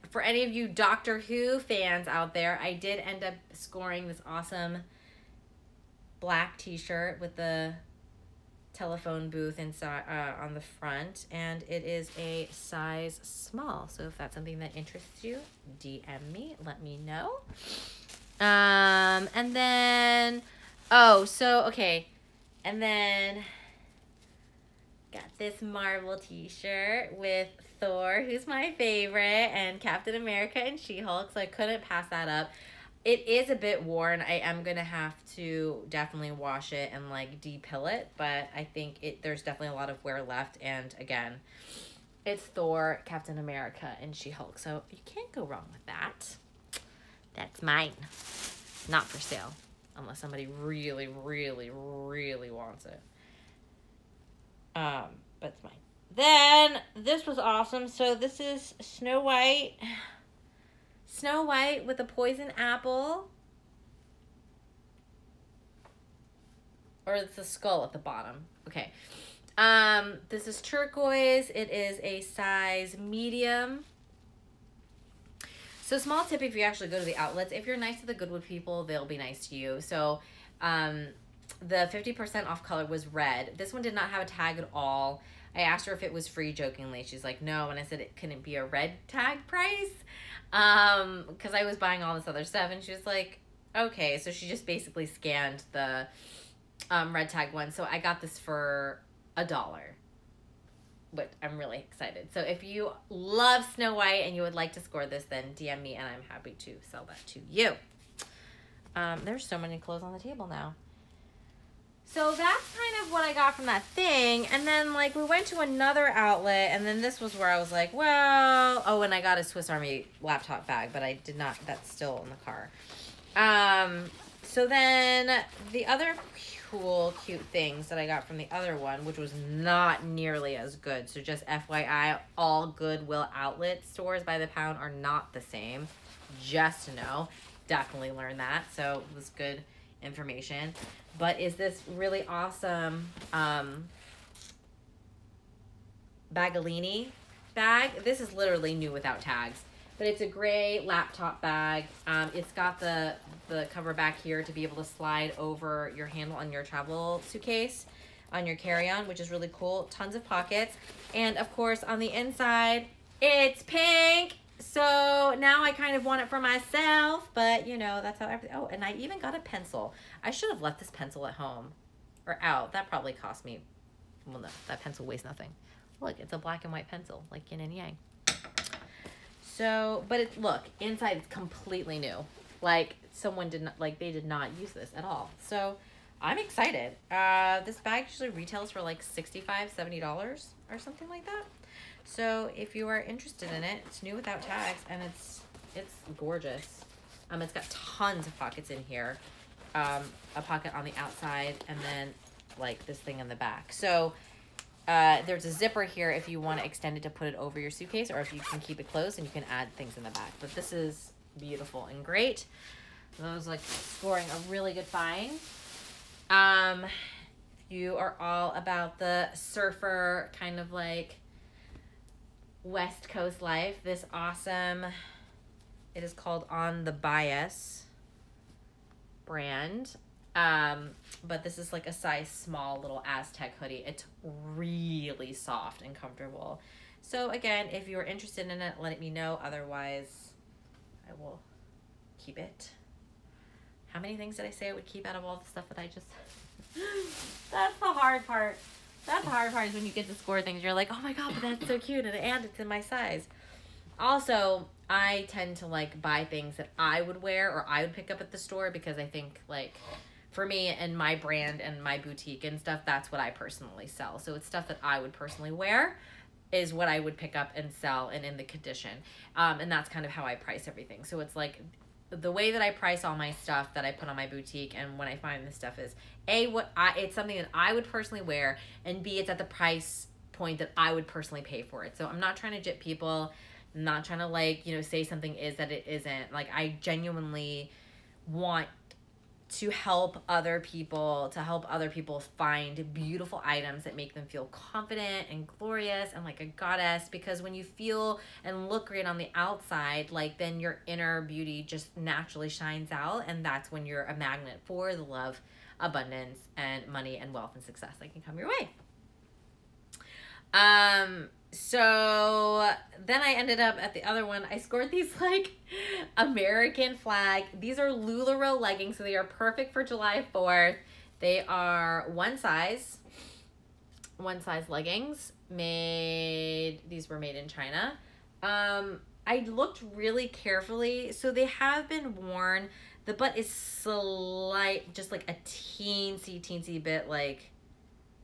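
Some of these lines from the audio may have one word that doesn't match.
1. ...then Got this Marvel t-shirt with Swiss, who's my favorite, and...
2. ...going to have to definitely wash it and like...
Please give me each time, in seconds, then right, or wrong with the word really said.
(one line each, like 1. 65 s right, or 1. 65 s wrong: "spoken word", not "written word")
1. 22 s wrong: "Thor", not "Swiss"
2. 34 s right.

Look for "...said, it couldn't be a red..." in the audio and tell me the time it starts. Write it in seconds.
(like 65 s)
87 s.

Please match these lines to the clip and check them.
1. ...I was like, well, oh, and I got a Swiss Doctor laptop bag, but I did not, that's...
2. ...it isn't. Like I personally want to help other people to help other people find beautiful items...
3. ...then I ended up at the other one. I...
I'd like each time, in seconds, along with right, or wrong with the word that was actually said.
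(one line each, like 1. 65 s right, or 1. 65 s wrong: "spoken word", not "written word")
1. 117 s wrong: "Army", not "Doctor"
2. 285 s wrong: "genuinely", not "personally"
3. 313 s right.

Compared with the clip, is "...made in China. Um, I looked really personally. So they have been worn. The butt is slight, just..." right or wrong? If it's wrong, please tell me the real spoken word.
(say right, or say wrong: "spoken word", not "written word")
wrong: "carefully", not "personally".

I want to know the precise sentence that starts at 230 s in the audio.
Um, but this is like a size small little Aztec hoodie.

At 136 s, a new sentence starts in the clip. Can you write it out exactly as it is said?
Just to know, definitely learned that.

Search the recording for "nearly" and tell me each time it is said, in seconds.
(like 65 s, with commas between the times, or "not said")
130 s.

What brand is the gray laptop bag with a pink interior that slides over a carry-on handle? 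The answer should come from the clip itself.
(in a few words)
Baggallini.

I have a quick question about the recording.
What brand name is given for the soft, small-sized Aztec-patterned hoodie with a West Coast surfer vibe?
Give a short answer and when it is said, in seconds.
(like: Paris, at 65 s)
On the Byas, at 226 s.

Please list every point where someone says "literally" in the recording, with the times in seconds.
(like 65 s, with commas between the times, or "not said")
148 s.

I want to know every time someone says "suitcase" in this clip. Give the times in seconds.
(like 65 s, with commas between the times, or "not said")
157 s, 207 s.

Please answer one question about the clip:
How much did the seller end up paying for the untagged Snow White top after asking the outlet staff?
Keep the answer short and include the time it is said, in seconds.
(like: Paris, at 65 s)
$1, at 99 s.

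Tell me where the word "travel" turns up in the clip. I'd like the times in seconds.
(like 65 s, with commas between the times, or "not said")
156 s.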